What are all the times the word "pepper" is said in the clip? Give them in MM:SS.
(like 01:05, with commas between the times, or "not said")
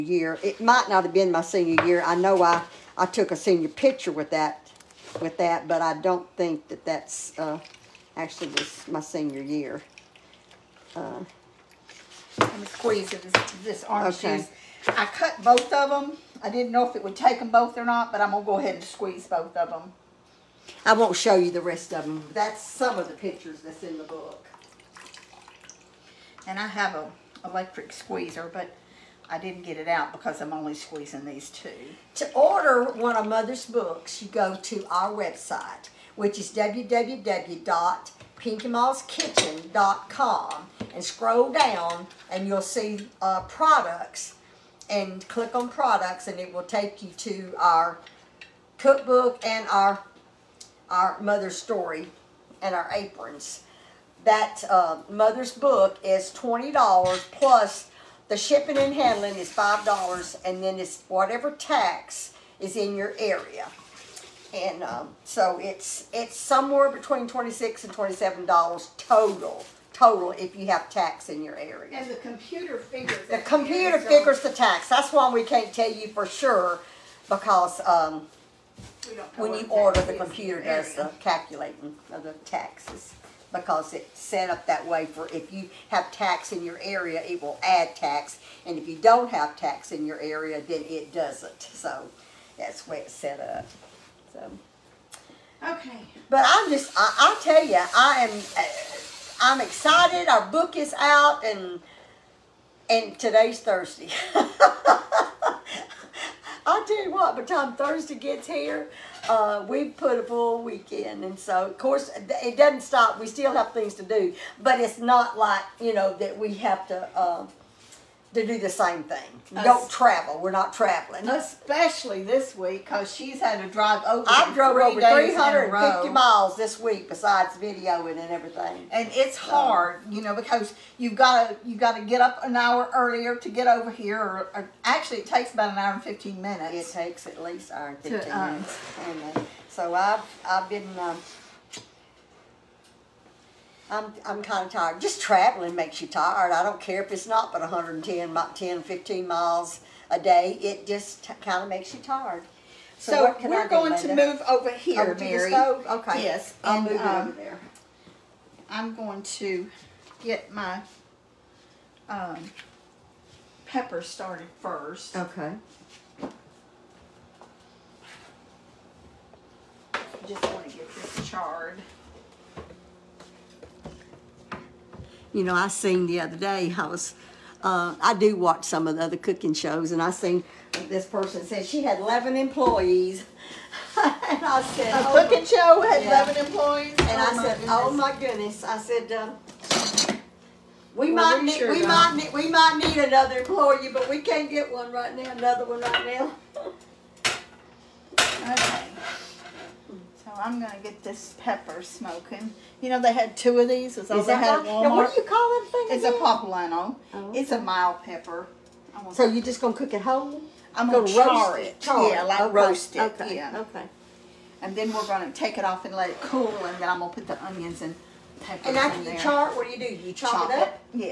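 02:43, 03:21, 03:28, 03:38.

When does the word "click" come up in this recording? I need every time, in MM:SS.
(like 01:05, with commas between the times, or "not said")
00:45.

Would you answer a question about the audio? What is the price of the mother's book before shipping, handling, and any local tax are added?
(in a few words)
$20.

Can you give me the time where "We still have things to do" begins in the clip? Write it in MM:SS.
01:53.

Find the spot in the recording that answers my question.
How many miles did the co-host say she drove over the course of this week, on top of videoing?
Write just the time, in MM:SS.
02:04.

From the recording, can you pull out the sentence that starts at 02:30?
It just kind of makes you tired.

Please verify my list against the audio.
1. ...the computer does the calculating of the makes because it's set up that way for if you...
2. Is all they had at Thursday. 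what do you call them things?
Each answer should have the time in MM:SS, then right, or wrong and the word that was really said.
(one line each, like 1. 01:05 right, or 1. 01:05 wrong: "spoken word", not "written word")
1. 01:20 wrong: "taxes", not "makes"
2. 03:23 wrong: "Walmart", not "Thursday".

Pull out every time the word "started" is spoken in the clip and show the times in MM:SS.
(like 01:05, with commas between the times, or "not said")
02:44.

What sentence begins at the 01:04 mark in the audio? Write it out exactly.
And um, so it's it's somewhere between 26 and $27 total, total if you have tax in your area.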